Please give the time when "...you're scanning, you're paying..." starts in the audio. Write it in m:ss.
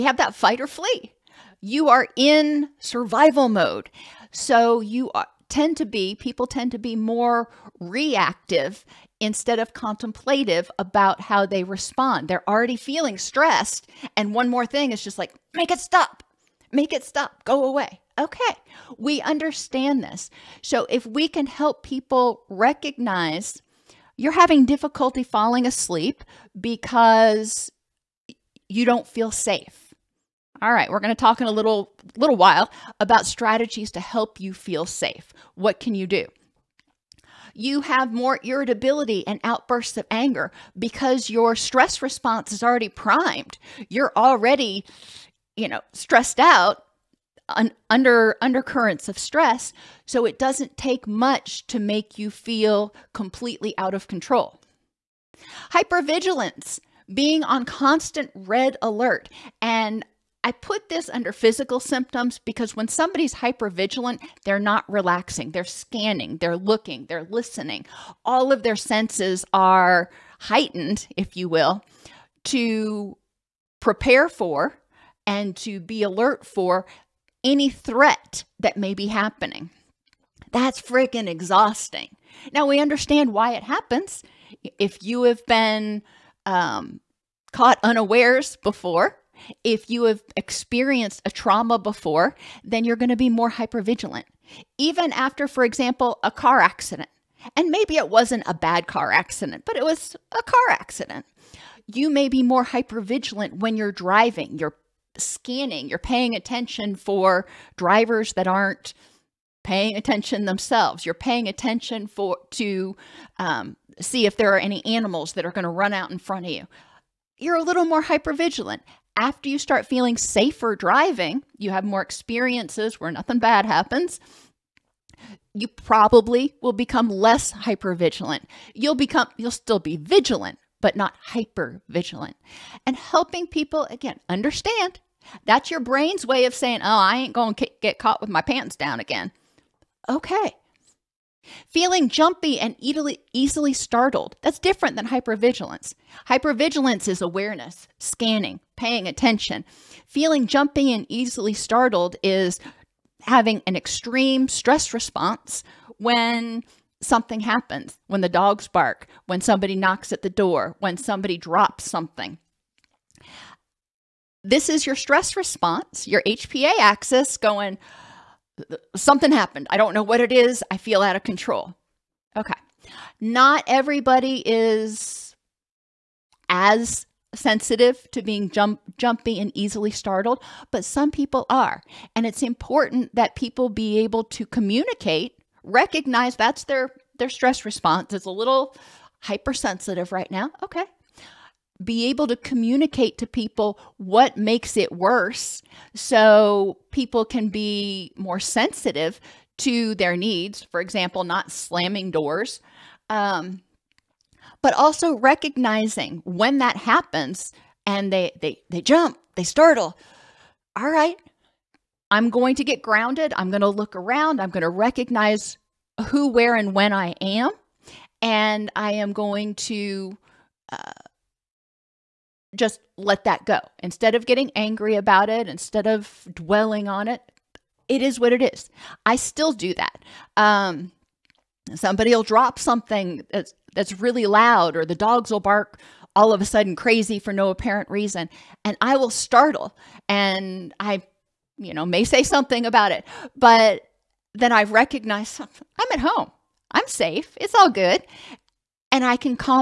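1:44.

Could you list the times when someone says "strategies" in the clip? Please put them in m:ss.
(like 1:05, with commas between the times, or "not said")
0:33.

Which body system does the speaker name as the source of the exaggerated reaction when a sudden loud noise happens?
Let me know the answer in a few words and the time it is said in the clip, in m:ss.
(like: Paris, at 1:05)
HPA axis, at 2:46.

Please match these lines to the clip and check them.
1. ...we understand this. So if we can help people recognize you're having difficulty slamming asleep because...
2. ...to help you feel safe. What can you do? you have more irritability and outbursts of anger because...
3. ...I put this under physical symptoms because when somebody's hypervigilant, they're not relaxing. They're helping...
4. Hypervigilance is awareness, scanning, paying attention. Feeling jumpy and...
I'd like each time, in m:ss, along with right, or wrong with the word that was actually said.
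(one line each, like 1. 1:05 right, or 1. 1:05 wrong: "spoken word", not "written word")
1. 0:18 wrong: "falling", not "slamming"
2. 0:33 right
3. 1:00 wrong: "scanning", not "helping"
4. 2:26 right.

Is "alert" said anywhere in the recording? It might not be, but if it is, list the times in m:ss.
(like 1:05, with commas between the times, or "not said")
0:58, 1:16.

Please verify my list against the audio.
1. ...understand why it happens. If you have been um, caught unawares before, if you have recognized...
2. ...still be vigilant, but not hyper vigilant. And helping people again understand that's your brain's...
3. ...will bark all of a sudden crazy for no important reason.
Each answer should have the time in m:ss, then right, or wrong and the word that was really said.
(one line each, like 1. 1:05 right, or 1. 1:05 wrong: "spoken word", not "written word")
1. 1:22 wrong: "experienced", not "recognized"
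2. 2:09 right
3. 3:55 wrong: "apparent", not "important".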